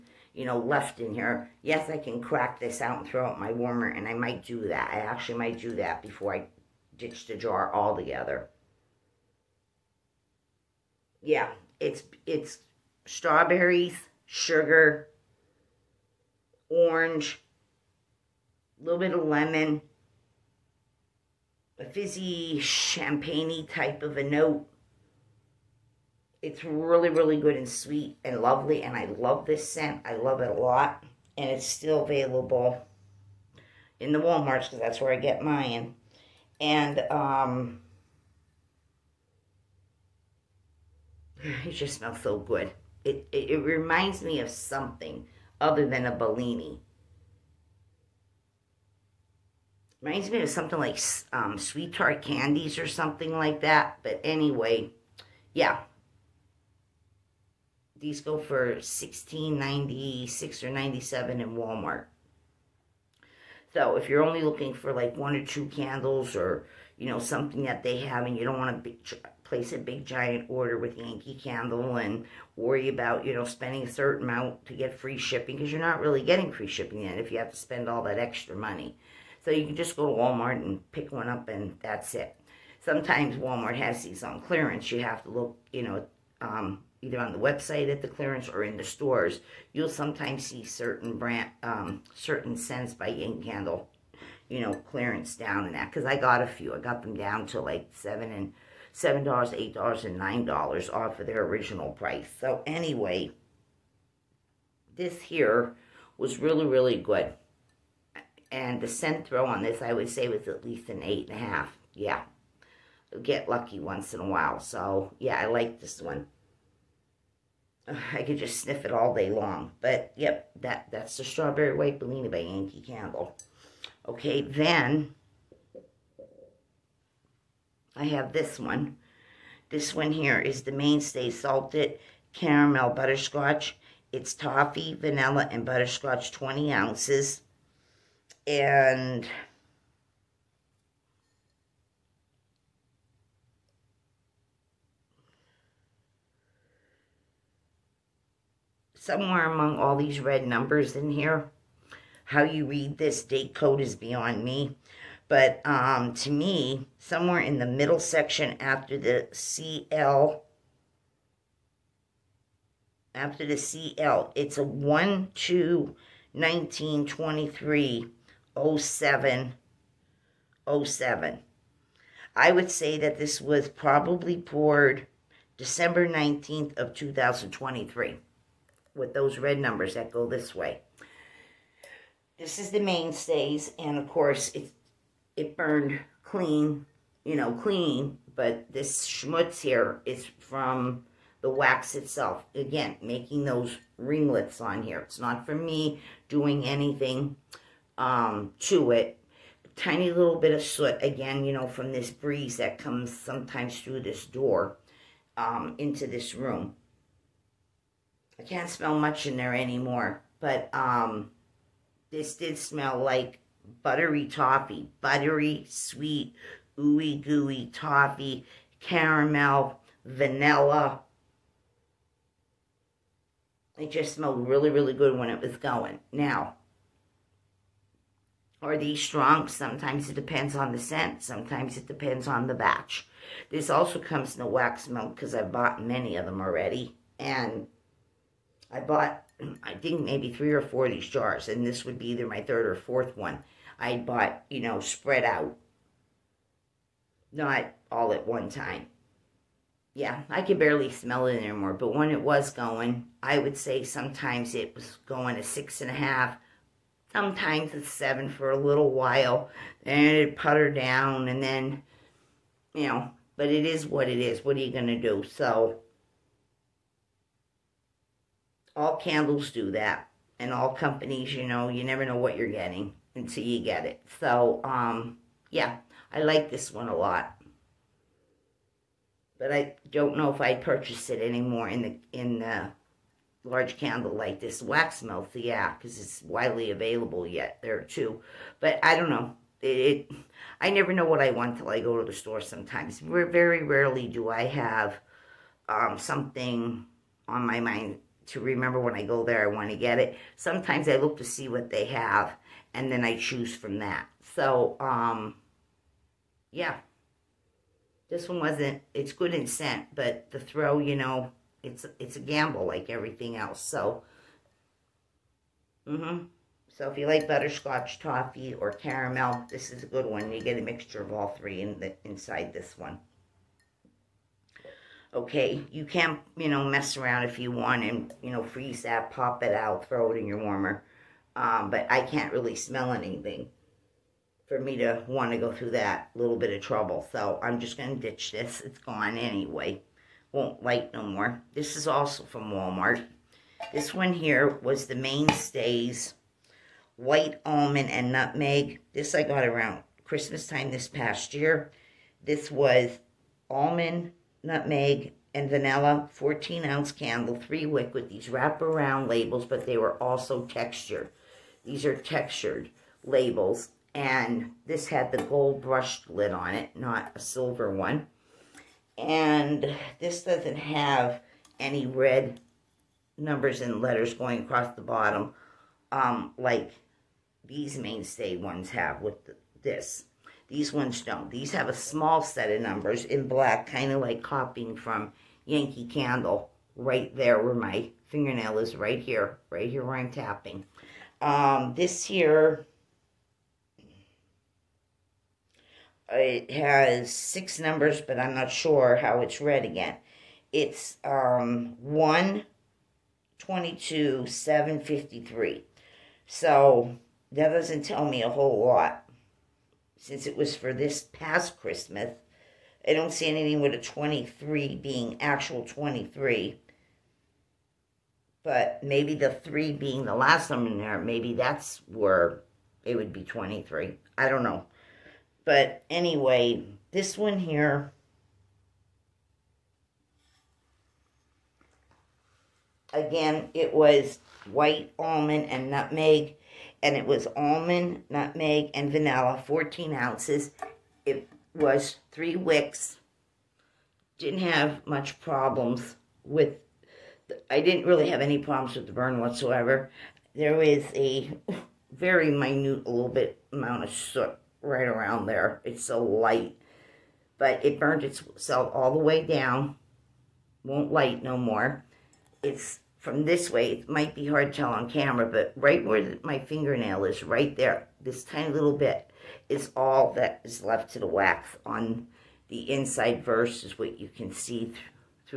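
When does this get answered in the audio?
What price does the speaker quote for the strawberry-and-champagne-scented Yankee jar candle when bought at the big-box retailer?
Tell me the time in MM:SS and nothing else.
00:58.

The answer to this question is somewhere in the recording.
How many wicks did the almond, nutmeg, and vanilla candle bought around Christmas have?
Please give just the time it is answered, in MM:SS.
07:22.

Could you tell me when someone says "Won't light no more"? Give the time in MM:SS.
07:40.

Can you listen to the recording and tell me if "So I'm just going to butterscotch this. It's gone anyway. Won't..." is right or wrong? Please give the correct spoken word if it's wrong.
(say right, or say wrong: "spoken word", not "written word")
wrong: "ditch", not "butterscotch".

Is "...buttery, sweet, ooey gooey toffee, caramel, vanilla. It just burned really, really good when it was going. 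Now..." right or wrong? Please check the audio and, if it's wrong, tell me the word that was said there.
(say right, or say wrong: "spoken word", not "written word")
wrong: "smelled", not "burned".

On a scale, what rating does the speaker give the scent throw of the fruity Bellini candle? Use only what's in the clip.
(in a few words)
8.5.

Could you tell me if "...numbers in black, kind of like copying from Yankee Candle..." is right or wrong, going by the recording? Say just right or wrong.
right.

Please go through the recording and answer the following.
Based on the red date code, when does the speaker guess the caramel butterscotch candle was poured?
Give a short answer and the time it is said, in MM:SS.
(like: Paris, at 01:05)
December 19, 2023, at 02:55.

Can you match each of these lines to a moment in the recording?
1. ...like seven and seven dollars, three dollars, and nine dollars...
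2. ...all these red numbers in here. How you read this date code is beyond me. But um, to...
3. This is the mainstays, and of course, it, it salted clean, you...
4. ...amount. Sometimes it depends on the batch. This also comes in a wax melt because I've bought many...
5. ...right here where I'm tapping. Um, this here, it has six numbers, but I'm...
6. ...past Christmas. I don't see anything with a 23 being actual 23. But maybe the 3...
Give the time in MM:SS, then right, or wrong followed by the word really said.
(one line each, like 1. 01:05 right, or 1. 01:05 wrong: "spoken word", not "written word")
1. 01:37 wrong: "eight", not "three"
2. 02:29 right
3. 03:02 wrong: "burned", not "salted"
4. 03:50 wrong: "scent", not "amount"
5. 06:29 right
6. 06:51 right.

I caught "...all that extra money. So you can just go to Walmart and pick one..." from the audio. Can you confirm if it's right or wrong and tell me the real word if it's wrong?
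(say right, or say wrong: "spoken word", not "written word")
right.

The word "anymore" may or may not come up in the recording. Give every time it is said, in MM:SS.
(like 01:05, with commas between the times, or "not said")
03:29, 04:11, 04:41.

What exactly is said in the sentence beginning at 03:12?
Again, making those ringlets on here.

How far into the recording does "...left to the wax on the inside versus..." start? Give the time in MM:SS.
07:50.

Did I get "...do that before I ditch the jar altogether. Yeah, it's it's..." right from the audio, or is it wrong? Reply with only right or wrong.
right.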